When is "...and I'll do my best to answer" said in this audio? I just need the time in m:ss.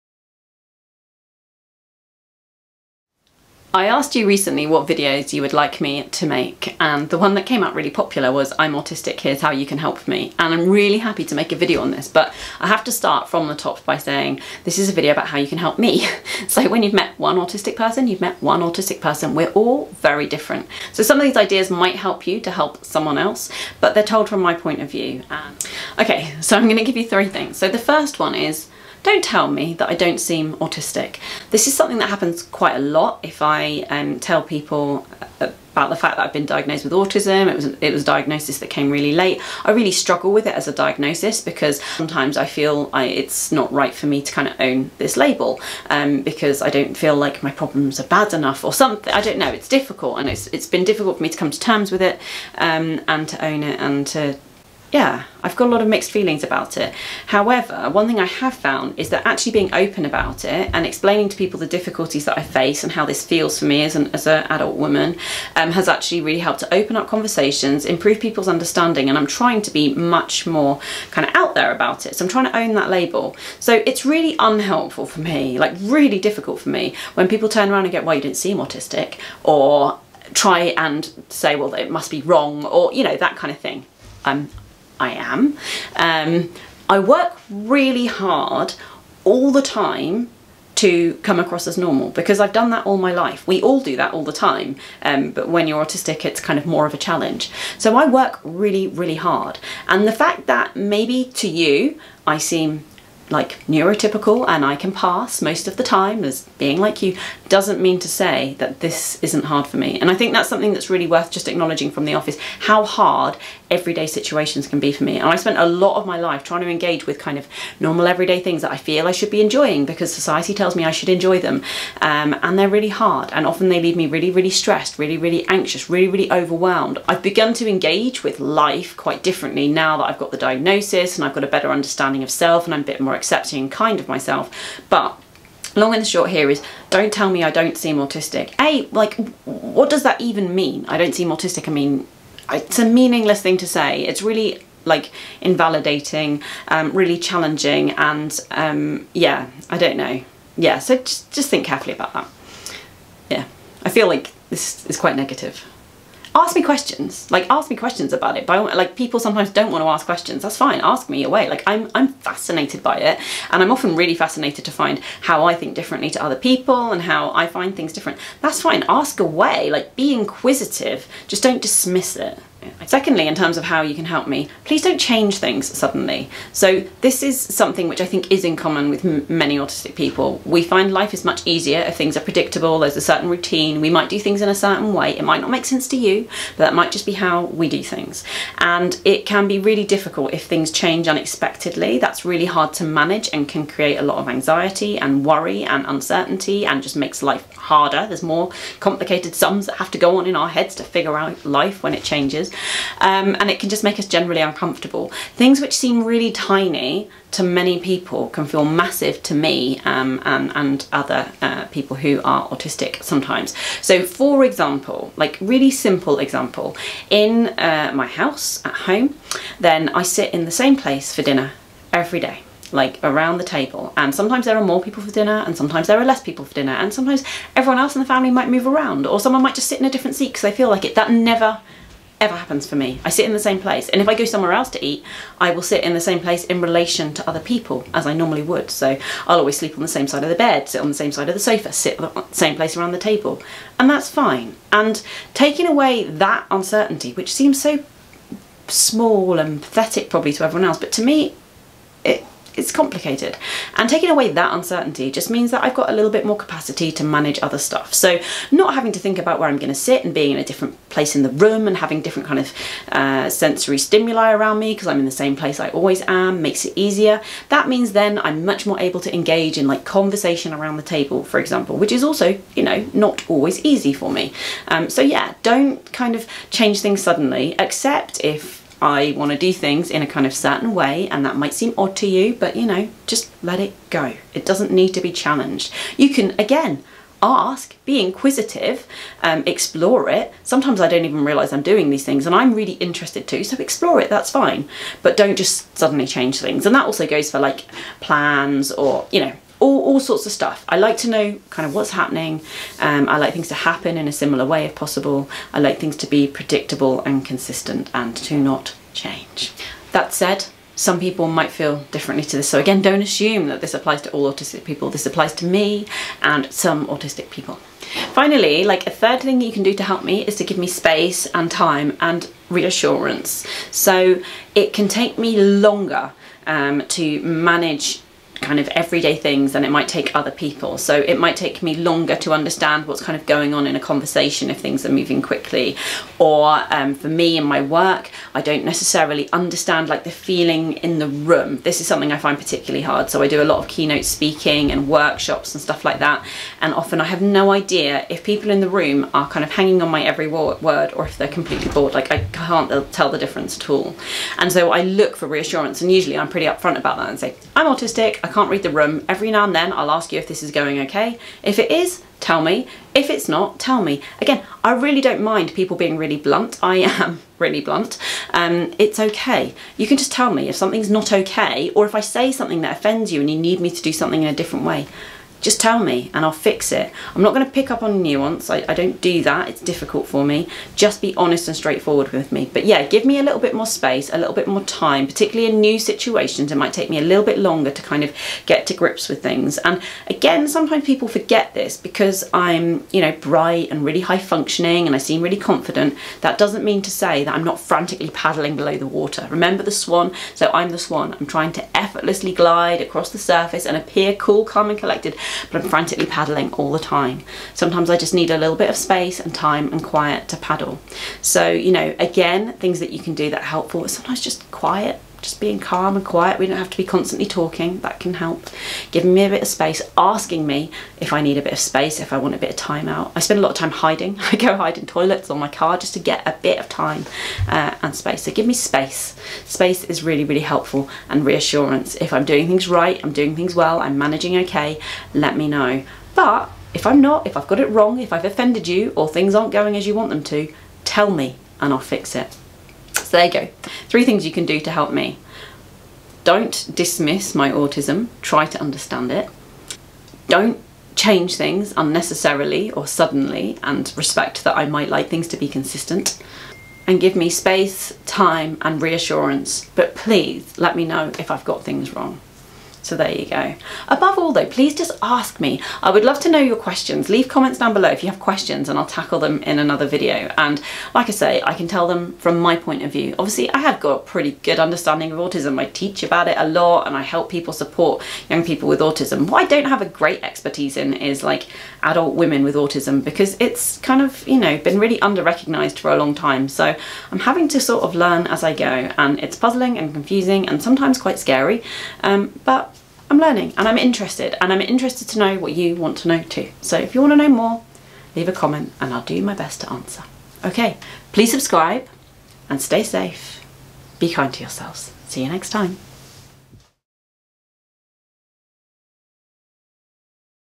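8:18.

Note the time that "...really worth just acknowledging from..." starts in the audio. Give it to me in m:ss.
1:50.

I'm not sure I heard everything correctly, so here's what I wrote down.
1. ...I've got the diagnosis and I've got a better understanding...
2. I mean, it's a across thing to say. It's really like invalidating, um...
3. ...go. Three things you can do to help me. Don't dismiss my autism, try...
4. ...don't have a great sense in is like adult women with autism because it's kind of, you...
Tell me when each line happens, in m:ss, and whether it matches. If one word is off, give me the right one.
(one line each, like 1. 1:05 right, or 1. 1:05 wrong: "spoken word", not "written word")
1. 2:10 right
2. 2:21 wrong: "meaningless", not "across"
3. 7:23 right
4. 7:59 wrong: "expertise", not "sense".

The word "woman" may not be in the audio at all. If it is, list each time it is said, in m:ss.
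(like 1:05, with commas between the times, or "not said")
1:04.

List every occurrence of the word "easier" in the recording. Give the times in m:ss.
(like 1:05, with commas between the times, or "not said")
3:01, 4:26.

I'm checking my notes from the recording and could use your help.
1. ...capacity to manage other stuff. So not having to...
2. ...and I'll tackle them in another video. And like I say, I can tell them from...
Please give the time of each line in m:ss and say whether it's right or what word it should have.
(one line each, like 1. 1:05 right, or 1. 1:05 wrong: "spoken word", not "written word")
1. 4:16 right
2. 7:48 right.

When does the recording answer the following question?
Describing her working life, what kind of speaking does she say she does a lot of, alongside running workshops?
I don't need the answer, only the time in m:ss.
5:43.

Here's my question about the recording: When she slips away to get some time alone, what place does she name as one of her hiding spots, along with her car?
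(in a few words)
toilets.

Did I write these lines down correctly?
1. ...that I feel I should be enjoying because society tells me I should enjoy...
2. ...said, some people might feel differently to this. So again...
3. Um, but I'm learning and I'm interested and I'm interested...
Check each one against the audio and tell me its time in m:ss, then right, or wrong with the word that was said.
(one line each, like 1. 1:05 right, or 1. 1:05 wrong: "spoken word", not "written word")
1. 1:58 right
2. 5:10 right
3. 8:12 right.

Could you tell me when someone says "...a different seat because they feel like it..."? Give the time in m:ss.
3:49.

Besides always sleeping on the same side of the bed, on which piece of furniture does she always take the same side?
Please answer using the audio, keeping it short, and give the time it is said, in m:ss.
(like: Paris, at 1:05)
sofa, at 4:01.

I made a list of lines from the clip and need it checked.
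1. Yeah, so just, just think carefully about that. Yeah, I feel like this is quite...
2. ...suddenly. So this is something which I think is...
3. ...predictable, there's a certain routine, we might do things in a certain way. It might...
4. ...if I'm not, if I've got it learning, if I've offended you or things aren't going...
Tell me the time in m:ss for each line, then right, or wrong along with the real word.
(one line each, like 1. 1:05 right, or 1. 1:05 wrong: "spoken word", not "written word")
1. 2:30 right
2. 2:55 right
3. 3:02 right
4. 7:16 wrong: "wrong", not "learning".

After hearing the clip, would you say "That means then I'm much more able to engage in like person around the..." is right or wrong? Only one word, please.
wrong.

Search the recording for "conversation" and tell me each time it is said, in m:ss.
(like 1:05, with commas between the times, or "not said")
1:07, 4:29, 5:33.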